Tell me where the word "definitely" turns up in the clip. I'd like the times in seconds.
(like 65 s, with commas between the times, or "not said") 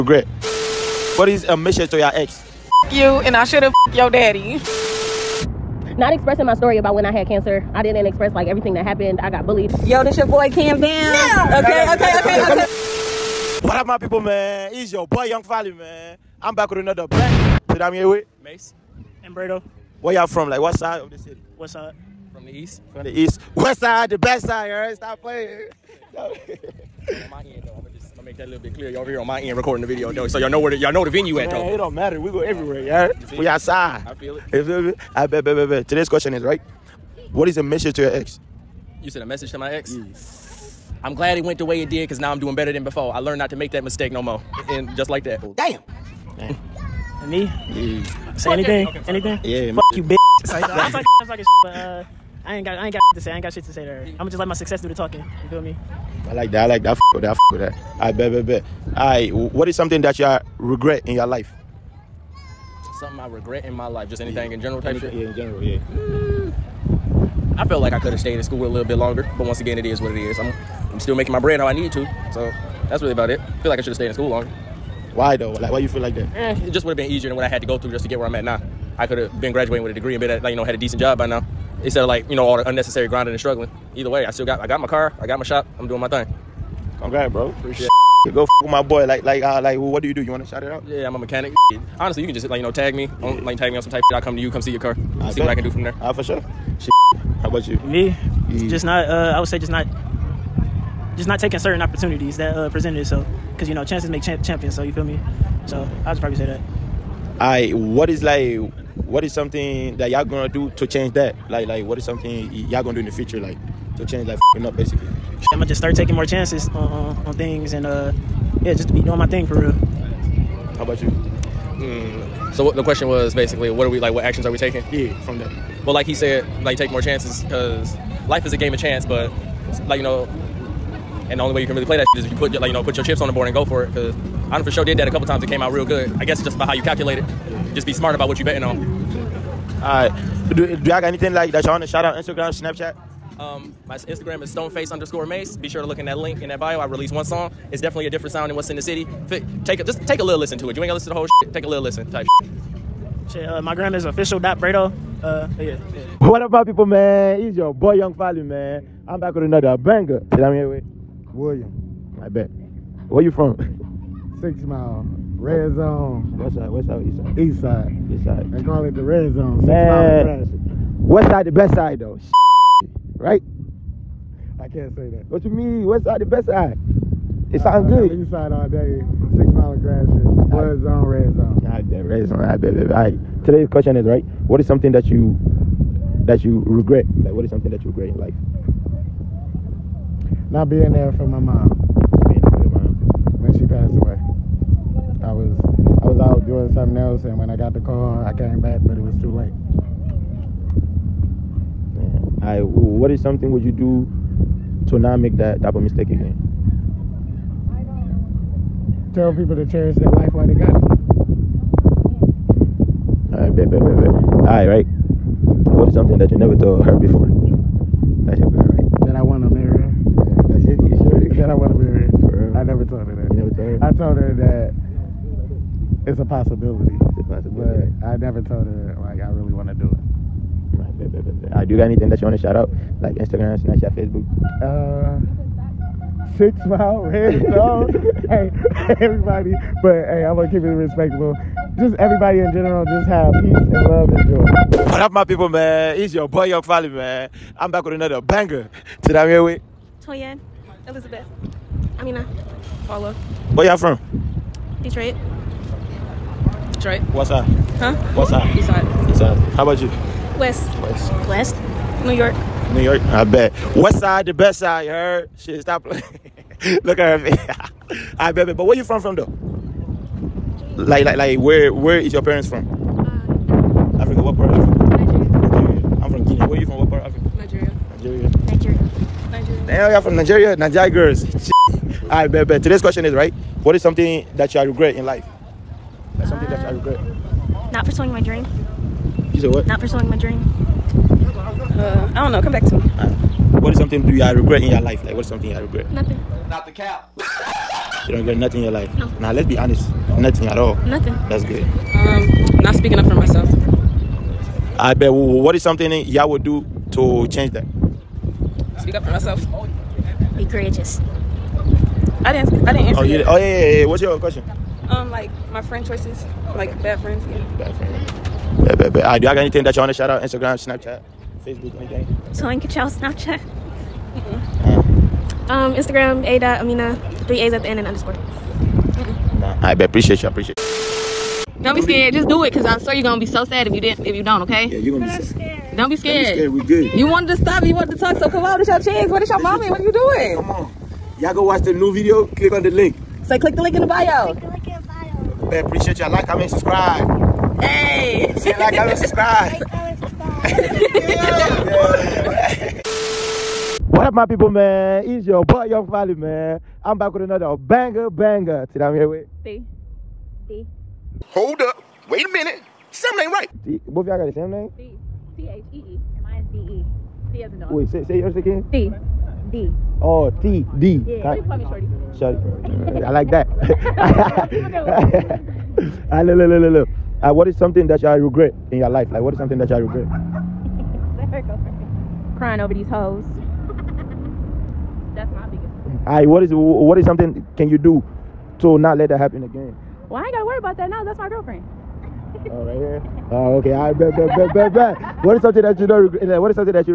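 147 s.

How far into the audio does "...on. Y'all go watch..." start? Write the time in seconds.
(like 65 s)
340 s.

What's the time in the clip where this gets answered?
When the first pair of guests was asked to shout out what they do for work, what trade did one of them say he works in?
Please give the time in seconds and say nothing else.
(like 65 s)
91 s.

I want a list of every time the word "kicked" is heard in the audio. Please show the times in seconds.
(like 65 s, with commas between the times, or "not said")
not said.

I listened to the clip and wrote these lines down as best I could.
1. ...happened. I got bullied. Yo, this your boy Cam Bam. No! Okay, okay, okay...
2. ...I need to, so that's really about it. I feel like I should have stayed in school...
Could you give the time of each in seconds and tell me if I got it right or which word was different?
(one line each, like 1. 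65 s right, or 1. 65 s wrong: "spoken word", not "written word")
1. 8 s right
2. 71 s right.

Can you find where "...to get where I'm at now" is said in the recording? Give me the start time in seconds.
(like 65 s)
78 s.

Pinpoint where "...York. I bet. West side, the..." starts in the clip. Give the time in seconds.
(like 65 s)
262 s.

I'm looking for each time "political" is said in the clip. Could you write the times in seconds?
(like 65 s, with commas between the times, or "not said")
not said.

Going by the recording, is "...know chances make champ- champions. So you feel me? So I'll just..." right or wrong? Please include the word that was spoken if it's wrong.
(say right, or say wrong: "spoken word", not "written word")
right.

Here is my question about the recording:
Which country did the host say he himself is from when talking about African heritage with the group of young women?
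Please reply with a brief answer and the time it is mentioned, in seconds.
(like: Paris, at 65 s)
Guinea, at 276 s.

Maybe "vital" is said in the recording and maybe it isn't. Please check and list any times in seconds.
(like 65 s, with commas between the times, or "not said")
not said.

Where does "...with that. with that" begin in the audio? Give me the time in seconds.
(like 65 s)
57 s.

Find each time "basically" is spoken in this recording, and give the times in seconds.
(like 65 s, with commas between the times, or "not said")
114 s, 123 s.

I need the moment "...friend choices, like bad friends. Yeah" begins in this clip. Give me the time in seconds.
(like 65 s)
315 s.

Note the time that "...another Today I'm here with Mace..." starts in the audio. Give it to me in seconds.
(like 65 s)
16 s.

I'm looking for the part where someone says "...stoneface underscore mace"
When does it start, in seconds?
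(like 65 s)
144 s.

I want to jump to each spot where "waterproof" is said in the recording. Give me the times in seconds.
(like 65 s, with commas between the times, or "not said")
not said.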